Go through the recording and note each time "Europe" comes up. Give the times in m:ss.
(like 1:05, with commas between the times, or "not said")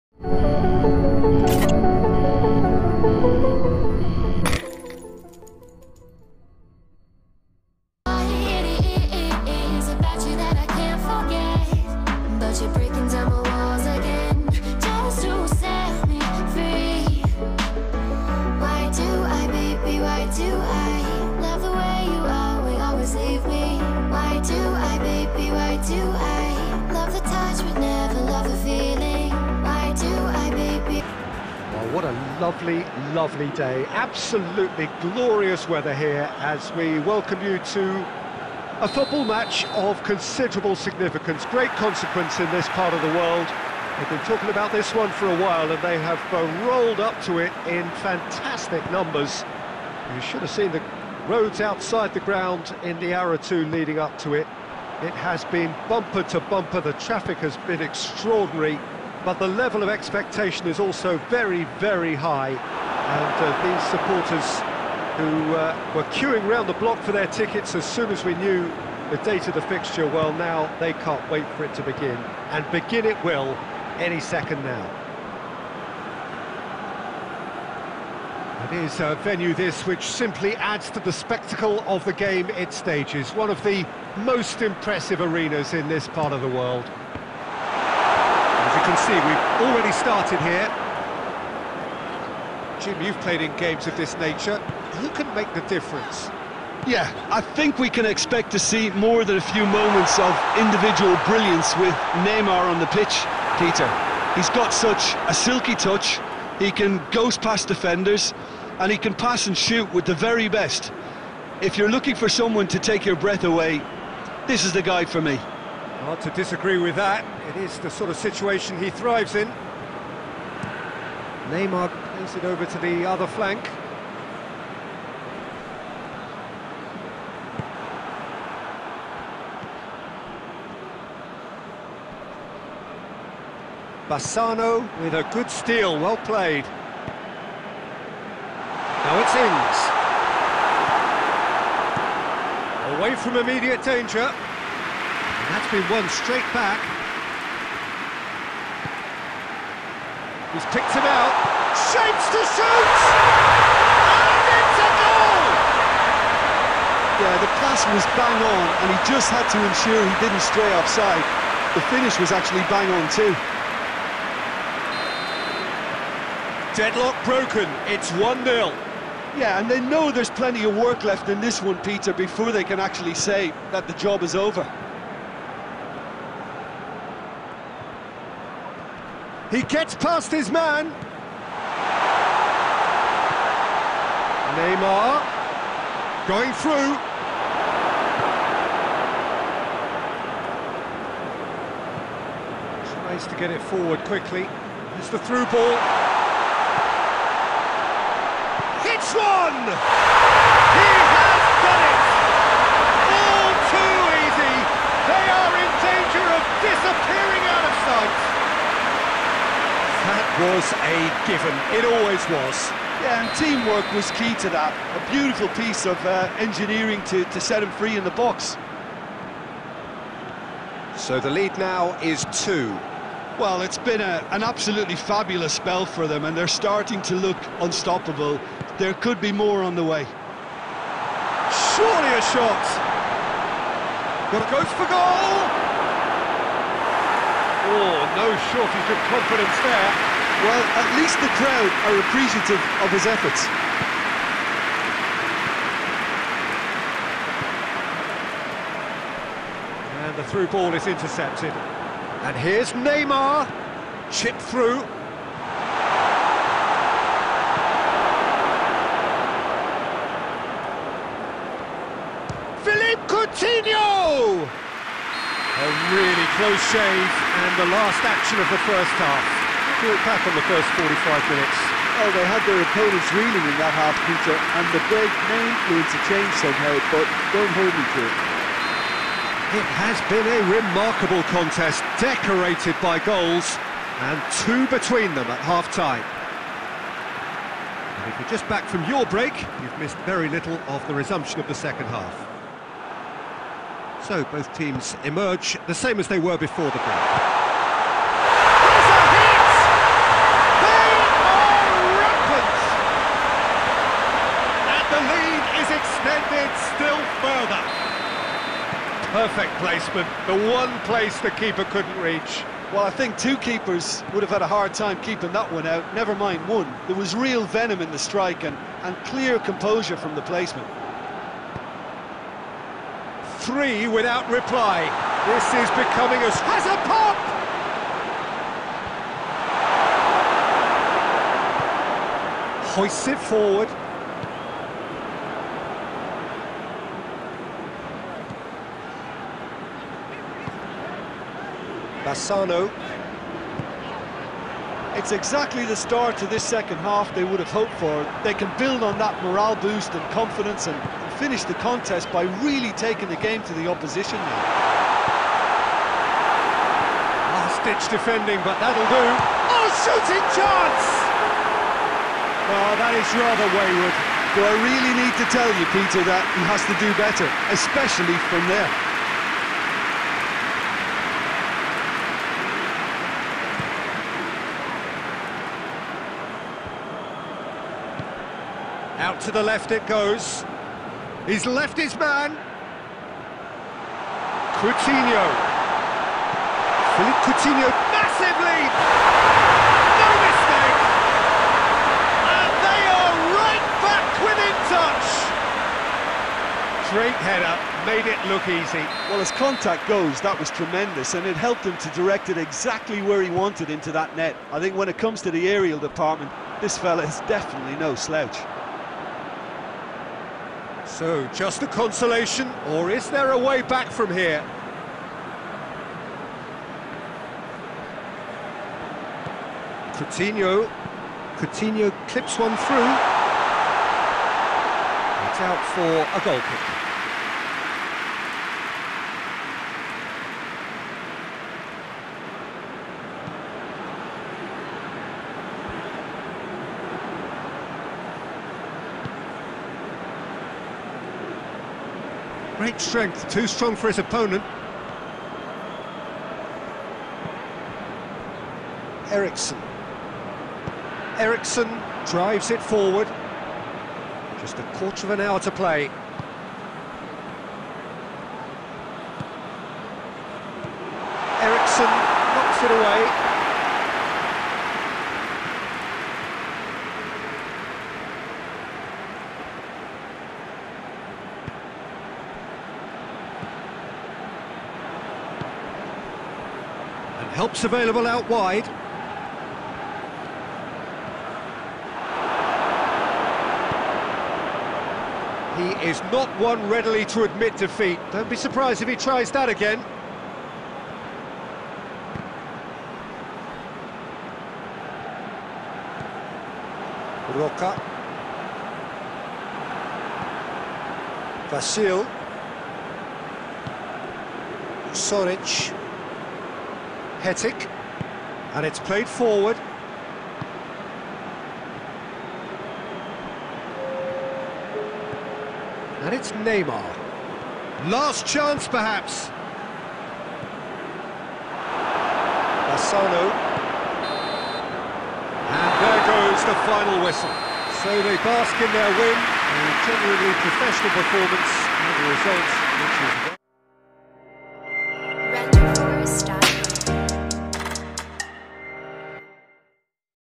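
not said.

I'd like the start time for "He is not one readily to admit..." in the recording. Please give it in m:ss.
8:05.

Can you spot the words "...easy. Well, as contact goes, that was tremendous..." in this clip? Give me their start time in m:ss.
6:38.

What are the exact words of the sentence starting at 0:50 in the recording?
You should have seen the roads outside the ground in the hour or two leading up to it.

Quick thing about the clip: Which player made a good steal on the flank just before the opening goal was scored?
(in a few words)
Bassano.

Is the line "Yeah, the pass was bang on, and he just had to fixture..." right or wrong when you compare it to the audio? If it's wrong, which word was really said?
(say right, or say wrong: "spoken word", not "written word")
wrong: "ensure", not "fixture".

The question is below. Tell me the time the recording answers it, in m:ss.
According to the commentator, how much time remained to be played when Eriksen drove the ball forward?
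7:34.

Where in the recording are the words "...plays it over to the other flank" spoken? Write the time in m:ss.
2:02.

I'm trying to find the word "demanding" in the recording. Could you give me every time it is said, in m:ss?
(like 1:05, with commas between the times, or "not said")
not said.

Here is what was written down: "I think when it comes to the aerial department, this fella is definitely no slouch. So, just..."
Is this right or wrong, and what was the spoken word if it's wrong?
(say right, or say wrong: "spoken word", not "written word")
right.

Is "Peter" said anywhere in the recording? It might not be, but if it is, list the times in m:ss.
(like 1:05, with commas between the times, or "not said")
1:43, 2:51, 4:34, 6:05.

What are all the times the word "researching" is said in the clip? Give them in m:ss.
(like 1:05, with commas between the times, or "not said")
not said.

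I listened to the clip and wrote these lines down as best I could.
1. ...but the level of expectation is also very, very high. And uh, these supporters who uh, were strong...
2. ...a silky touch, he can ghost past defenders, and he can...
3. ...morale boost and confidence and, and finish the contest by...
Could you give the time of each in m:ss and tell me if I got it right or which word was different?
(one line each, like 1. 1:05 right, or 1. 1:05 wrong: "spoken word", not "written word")
1. 0:59 wrong: "queuing", not "strong"
2. 1:45 right
3. 5:49 right.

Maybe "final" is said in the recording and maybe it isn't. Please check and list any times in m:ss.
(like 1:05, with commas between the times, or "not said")
8:46.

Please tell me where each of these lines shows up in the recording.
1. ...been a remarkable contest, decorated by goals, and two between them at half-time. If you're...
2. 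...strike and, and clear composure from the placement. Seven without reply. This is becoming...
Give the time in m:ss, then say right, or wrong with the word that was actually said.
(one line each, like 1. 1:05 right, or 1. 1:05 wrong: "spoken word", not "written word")
1. 4:40 right
2. 5:17 wrong: "Three", not "Seven".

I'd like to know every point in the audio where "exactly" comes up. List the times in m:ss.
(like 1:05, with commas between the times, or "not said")
5:45, 6:42.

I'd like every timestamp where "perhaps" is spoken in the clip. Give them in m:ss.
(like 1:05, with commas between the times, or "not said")
8:38.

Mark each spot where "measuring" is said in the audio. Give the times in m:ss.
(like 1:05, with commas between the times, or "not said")
not said.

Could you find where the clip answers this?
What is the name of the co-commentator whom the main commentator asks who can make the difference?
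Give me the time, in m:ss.
1:32.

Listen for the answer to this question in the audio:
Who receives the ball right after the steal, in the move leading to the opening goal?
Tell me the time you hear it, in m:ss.
2:22.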